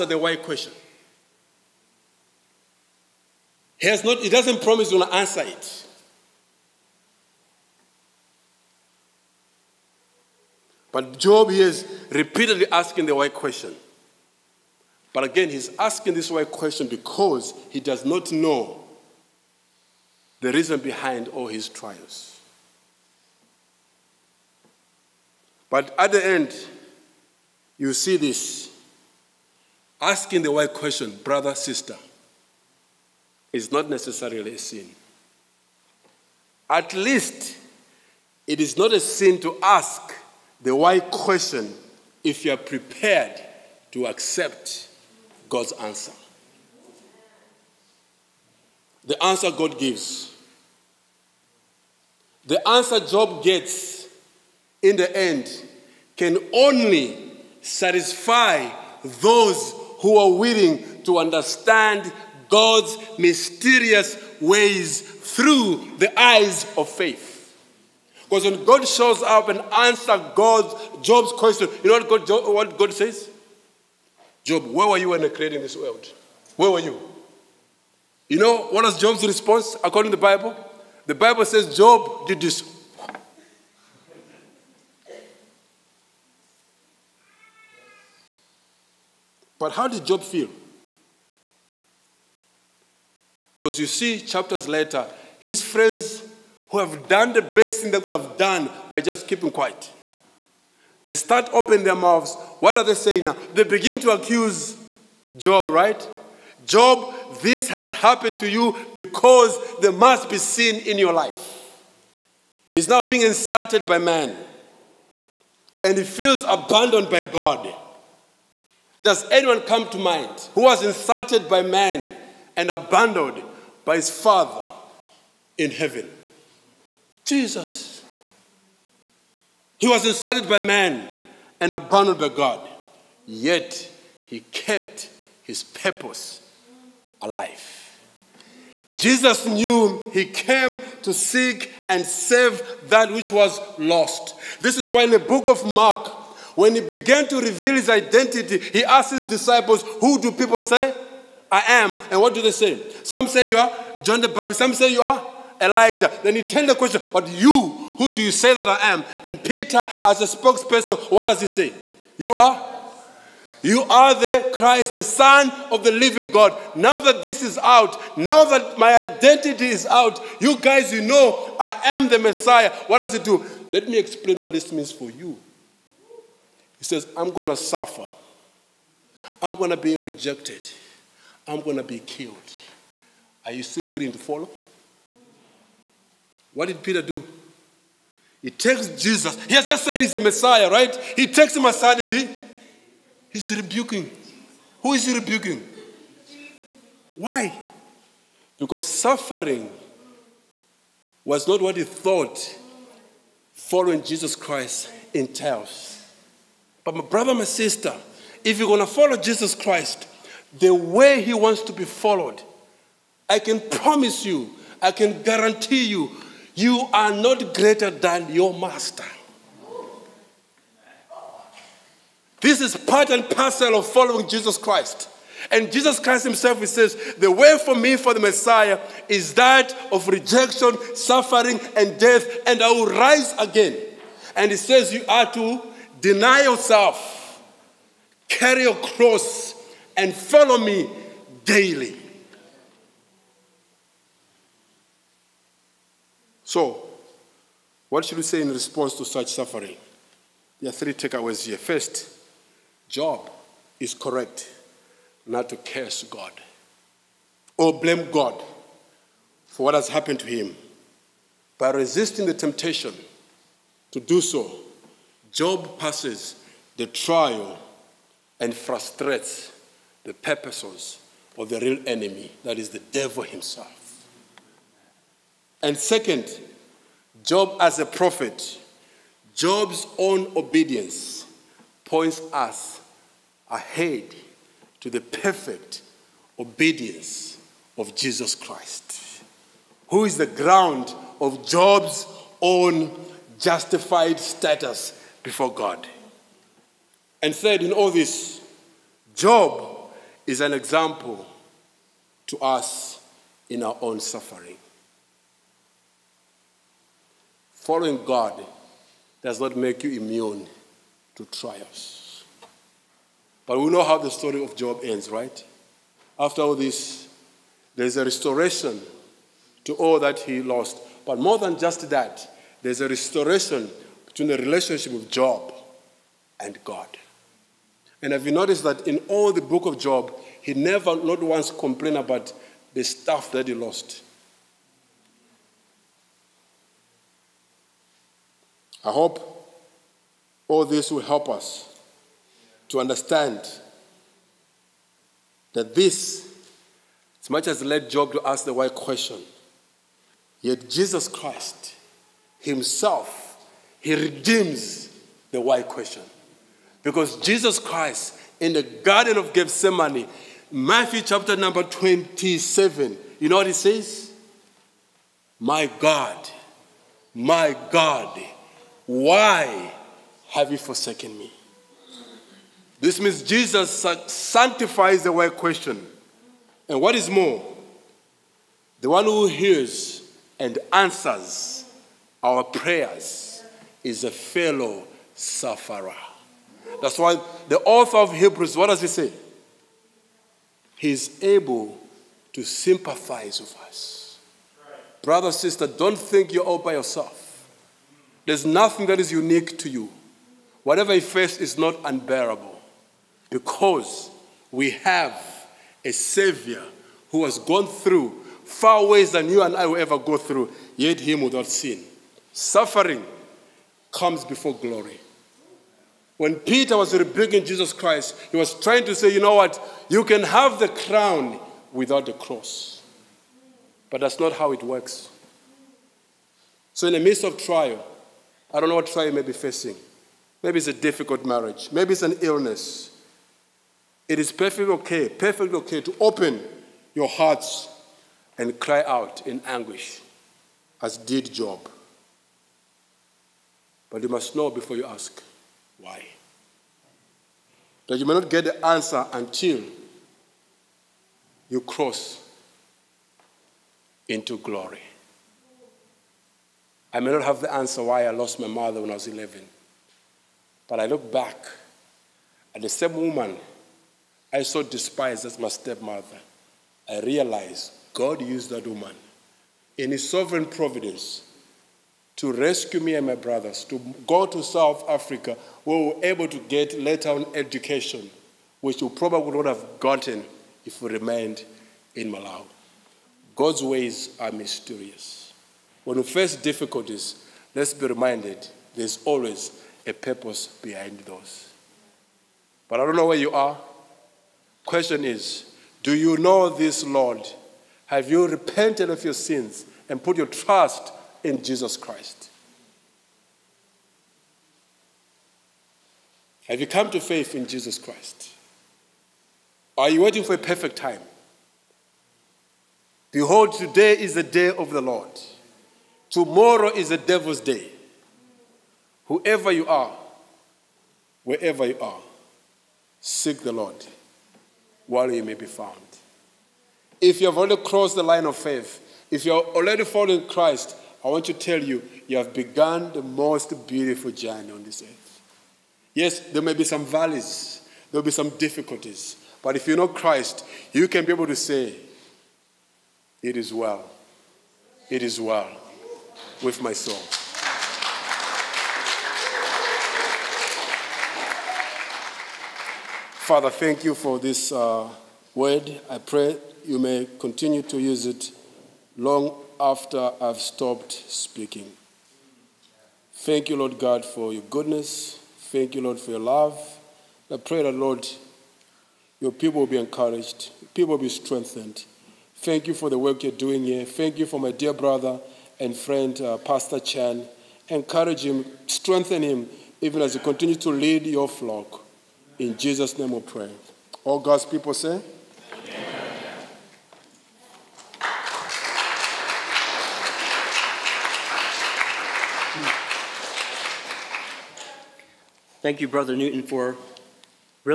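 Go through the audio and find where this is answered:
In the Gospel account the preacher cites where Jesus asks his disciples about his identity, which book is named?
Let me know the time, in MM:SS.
02:25.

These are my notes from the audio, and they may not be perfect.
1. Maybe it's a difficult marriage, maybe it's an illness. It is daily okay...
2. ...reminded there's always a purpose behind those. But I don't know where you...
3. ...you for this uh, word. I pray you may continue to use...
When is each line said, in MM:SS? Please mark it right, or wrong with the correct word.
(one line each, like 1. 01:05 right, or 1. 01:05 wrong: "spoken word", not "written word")
1. 07:10 wrong: "perfectly", not "daily"
2. 08:07 right
3. 09:13 right.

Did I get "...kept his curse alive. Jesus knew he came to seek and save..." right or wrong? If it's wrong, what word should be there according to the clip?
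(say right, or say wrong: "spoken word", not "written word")
wrong: "purpose", not "curse".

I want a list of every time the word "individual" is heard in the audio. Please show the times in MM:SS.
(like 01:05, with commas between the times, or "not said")
not said.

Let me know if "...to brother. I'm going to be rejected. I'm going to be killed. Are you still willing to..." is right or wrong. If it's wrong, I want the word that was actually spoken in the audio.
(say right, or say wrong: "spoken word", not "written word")
wrong: "suffer", not "brother".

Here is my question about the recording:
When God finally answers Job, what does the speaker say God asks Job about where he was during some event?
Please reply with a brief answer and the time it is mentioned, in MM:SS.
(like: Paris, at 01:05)
When I created this world, at 01:14.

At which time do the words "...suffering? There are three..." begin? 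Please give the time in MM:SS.
04:09.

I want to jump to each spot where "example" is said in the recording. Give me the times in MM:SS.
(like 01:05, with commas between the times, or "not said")
05:00.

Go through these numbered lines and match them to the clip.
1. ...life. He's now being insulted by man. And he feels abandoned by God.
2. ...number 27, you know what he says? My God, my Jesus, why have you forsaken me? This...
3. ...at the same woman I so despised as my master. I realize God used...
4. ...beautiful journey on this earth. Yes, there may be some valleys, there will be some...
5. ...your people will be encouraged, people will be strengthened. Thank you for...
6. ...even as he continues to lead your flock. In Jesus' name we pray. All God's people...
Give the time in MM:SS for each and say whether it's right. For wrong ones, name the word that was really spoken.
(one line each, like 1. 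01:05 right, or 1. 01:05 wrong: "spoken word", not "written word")
1. 01:51 right
2. 06:01 wrong: "God", not "Jesus"
3. 07:42 wrong: "stepmother", not "master"
4. 08:53 right
5. 09:29 right
6. 09:39 right.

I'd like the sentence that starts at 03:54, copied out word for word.
And he says, you are to deny yourself, carry your cross, and follow me daily.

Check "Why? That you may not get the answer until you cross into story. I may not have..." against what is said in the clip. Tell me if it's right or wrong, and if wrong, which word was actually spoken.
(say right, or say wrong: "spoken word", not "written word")
wrong: "glory", not "story".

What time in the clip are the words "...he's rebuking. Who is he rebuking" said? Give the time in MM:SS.
03:13.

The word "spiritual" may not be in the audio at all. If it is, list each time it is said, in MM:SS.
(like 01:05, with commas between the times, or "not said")
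not said.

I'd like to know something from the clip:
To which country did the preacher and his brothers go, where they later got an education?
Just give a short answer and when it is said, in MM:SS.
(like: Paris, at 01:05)
South Africa, at 07:54.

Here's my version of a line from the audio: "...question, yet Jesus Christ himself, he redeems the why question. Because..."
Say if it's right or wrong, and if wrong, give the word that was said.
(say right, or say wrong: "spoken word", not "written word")
right.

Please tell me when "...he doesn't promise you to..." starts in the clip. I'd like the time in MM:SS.
00:04.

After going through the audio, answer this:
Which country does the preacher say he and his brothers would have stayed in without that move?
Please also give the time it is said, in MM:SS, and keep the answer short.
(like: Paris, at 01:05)
Malawi, at 08:02.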